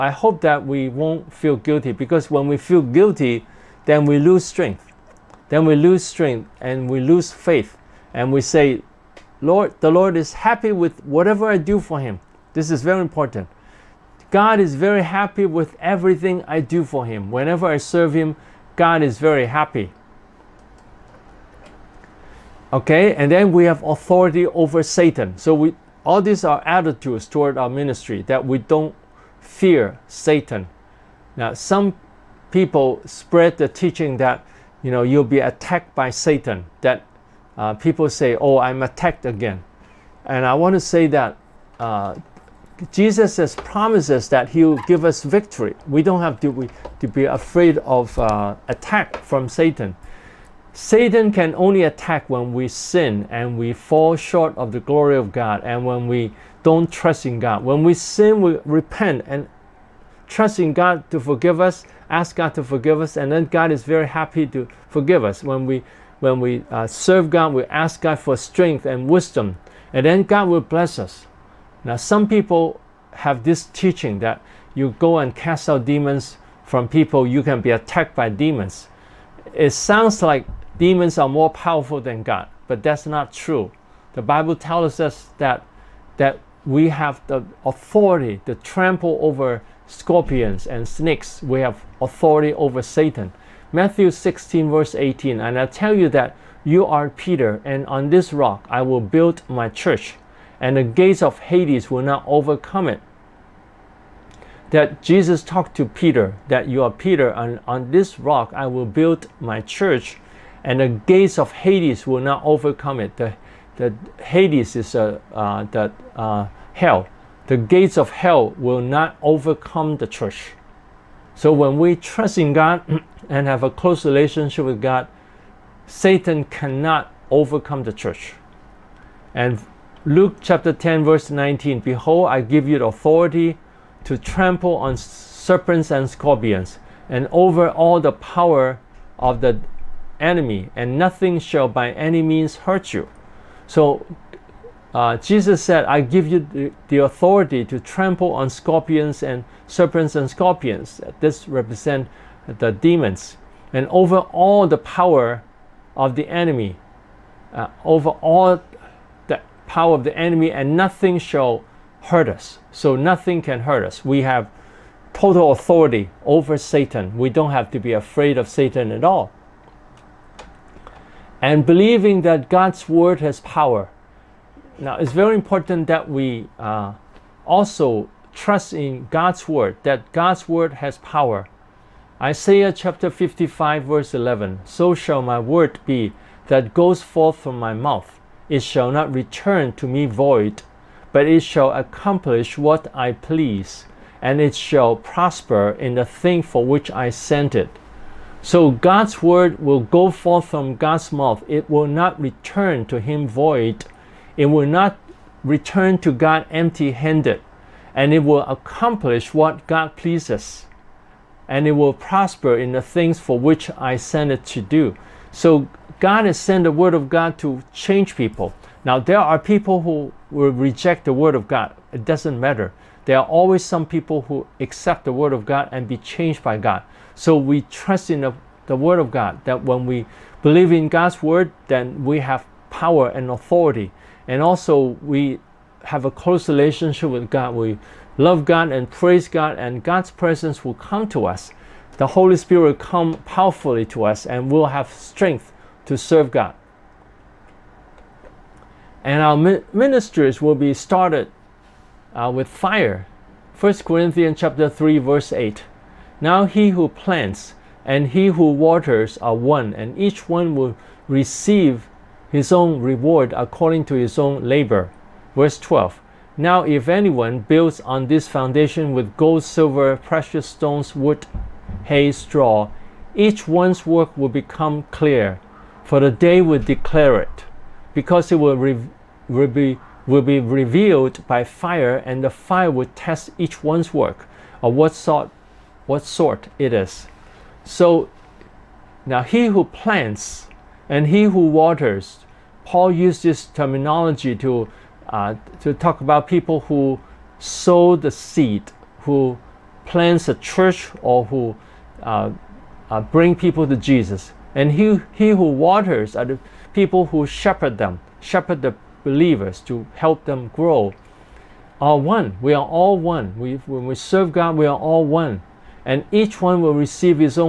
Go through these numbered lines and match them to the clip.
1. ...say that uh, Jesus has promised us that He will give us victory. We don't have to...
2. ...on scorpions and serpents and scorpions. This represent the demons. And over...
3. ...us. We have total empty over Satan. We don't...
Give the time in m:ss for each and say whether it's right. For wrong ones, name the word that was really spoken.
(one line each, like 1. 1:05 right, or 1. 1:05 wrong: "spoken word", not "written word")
1. 0:40 right
2. 2:28 right
3. 2:43 wrong: "authority", not "empty".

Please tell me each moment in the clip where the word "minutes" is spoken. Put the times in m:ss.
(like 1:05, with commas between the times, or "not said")
not said.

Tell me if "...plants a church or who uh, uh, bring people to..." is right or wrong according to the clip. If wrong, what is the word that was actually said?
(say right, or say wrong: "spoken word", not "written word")
right.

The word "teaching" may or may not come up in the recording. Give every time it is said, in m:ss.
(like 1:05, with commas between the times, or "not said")
0:33, 1:13.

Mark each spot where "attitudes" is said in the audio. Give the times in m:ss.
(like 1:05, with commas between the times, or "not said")
0:26.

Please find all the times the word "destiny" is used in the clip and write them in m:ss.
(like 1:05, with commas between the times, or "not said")
not said.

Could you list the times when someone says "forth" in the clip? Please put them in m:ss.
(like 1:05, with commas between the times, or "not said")
3:07, 3:20.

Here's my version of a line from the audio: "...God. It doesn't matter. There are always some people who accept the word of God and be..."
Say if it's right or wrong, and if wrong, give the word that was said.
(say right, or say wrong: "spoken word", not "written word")
right.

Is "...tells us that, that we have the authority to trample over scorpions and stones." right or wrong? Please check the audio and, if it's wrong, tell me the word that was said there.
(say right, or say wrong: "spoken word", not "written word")
wrong: "snakes", not "stones".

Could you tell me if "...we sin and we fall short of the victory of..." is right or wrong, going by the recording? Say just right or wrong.
wrong.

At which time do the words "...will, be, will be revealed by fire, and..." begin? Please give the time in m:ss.
4:39.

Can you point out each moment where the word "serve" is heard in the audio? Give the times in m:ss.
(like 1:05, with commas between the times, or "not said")
0:17, 1:06, 4:05, 5:13.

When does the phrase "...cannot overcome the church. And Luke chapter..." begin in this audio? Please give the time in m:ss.
2:06.